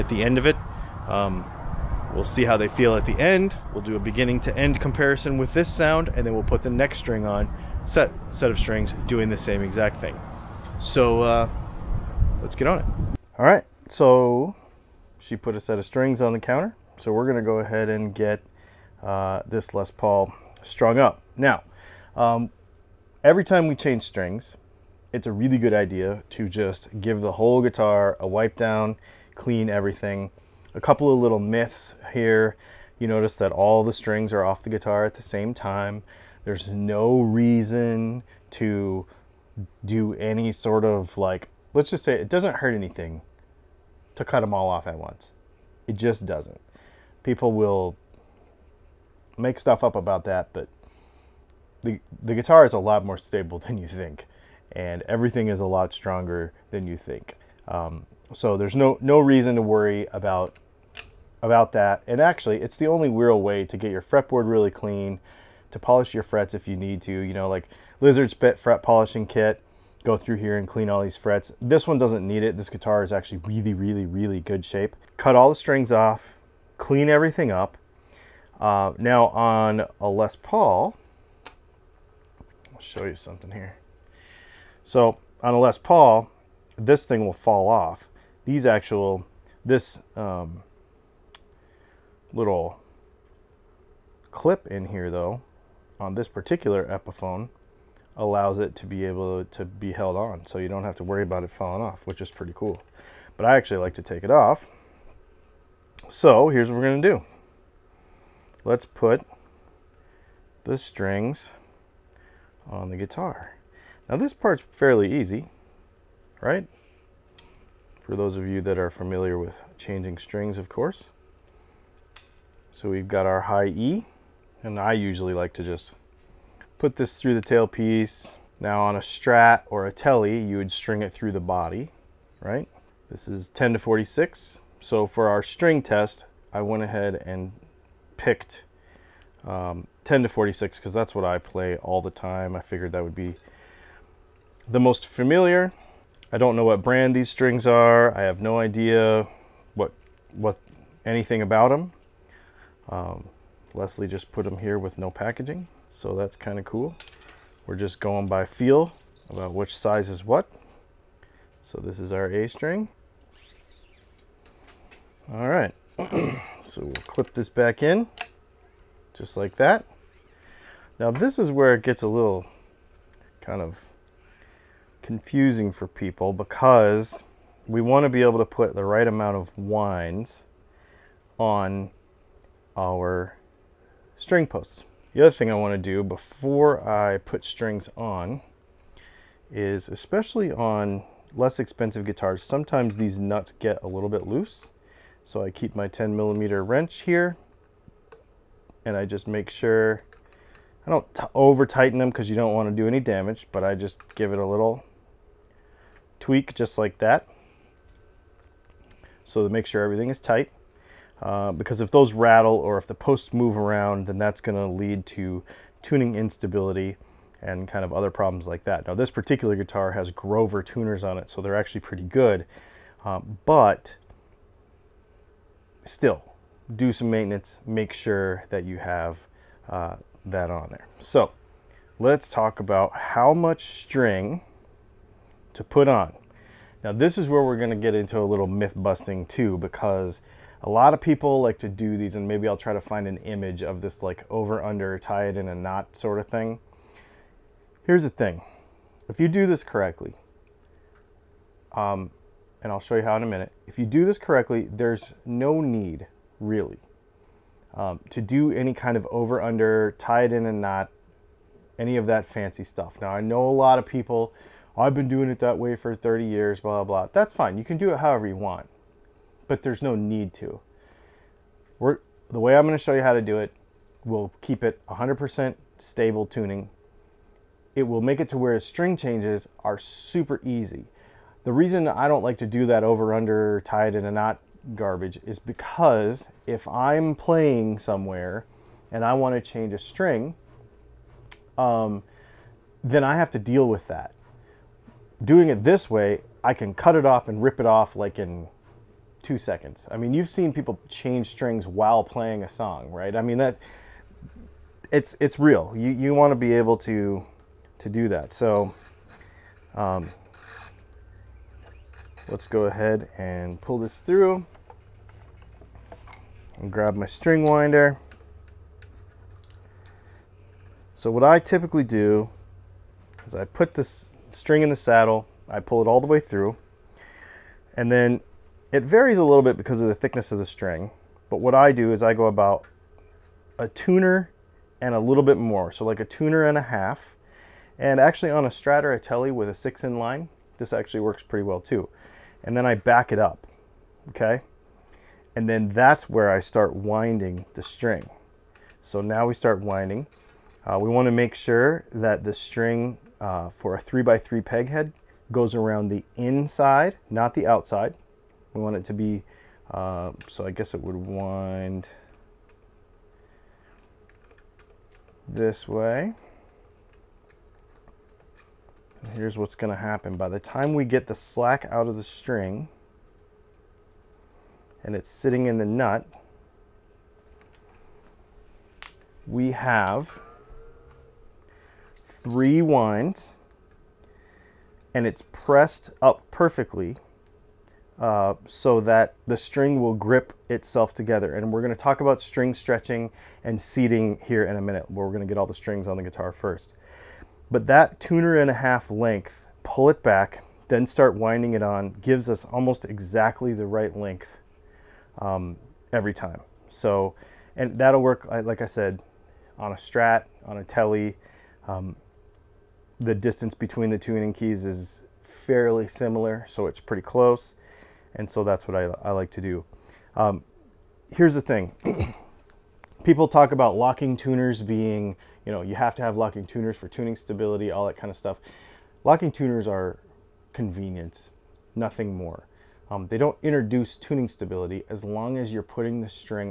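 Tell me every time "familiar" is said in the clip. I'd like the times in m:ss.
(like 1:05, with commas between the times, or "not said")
1:58, 2:25.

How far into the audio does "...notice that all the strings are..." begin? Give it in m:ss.
0:33.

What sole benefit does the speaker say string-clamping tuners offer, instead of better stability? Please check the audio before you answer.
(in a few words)
Convenience.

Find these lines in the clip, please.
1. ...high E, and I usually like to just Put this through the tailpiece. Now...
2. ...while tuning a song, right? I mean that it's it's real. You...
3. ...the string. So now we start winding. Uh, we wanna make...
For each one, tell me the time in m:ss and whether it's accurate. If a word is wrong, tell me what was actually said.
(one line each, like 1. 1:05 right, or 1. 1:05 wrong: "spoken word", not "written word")
1. 2:03 right
2. 5:01 wrong: "playing", not "tuning"
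3. 5:47 right.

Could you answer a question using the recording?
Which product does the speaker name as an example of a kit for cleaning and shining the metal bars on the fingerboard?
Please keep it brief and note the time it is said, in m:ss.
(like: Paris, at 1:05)
Lizard Spit Fret Polishing Kit, at 1:07.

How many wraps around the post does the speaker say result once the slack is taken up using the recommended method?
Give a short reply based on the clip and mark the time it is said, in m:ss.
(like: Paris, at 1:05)
3, at 6:22.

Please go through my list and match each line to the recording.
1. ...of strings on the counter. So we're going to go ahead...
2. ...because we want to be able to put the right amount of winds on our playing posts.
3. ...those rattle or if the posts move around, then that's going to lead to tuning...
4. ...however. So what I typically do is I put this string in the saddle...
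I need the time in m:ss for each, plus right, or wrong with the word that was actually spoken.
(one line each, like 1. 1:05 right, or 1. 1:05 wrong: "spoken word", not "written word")
1. 0:15 right
2. 2:56 wrong: "string", not "playing"
3. 3:31 right
4. 5:17 wrong: "winder", not "however".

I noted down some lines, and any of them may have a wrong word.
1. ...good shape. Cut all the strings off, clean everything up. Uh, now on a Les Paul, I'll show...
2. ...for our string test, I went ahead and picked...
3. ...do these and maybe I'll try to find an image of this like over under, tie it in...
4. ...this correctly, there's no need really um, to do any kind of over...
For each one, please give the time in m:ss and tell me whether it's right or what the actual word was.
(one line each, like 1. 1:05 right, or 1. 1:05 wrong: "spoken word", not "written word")
1. 1:14 right
2. 2:15 right
3. 4:01 right
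4. 4:14 right.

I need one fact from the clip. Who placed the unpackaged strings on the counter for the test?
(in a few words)
Leslie.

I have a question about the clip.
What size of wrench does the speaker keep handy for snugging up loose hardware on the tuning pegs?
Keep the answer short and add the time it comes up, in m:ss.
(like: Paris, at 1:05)
10 millimeter, at 3:15.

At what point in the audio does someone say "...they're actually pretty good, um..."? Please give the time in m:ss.
3:41.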